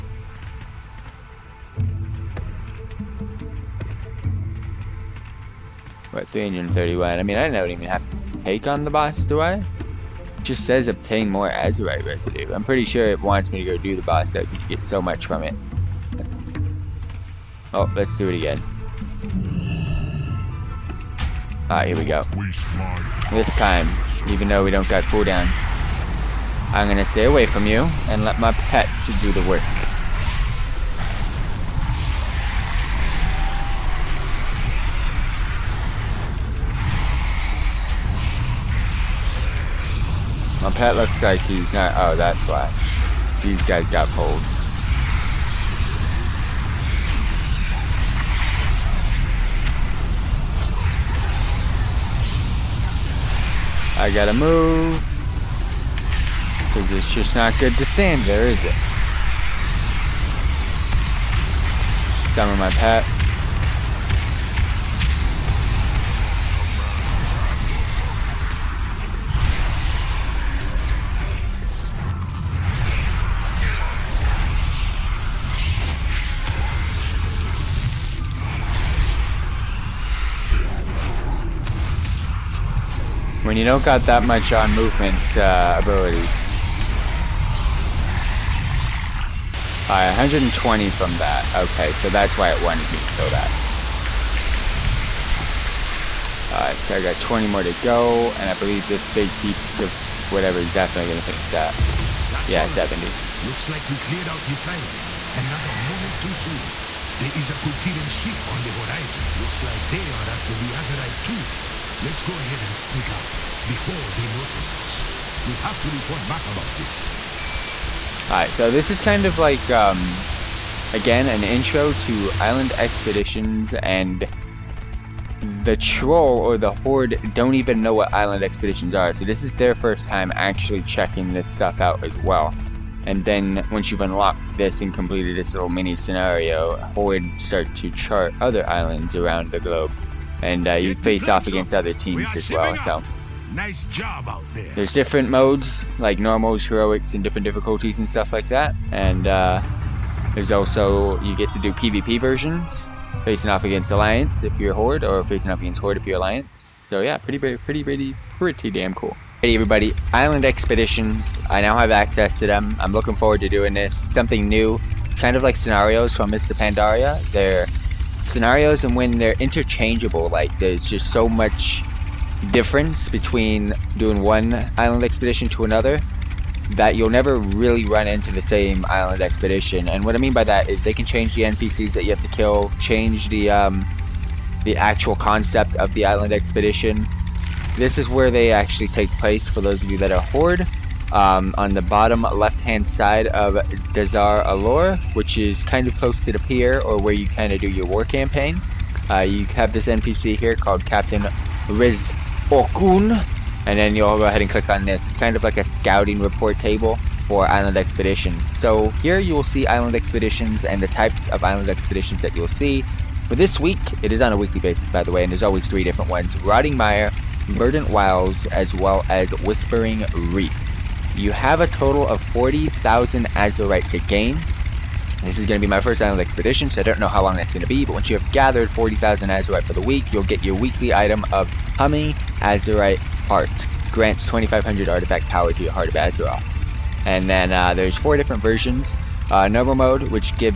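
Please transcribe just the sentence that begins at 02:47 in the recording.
They're scenarios and when they're interchangeable.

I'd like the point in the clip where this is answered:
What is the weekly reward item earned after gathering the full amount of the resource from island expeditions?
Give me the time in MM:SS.
03:51.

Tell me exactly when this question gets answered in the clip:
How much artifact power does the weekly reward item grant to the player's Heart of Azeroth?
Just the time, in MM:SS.
03:54.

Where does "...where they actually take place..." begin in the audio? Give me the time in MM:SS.
03:08.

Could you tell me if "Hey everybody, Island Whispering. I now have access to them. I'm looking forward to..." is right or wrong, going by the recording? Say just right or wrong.
wrong.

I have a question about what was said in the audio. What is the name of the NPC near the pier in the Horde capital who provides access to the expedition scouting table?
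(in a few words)
Captain Riz Okun.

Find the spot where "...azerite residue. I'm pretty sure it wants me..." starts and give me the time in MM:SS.
00:11.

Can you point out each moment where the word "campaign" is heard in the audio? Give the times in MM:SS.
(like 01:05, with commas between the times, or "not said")
03:18.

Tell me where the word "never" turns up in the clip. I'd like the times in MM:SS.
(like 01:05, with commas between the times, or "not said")
02:57.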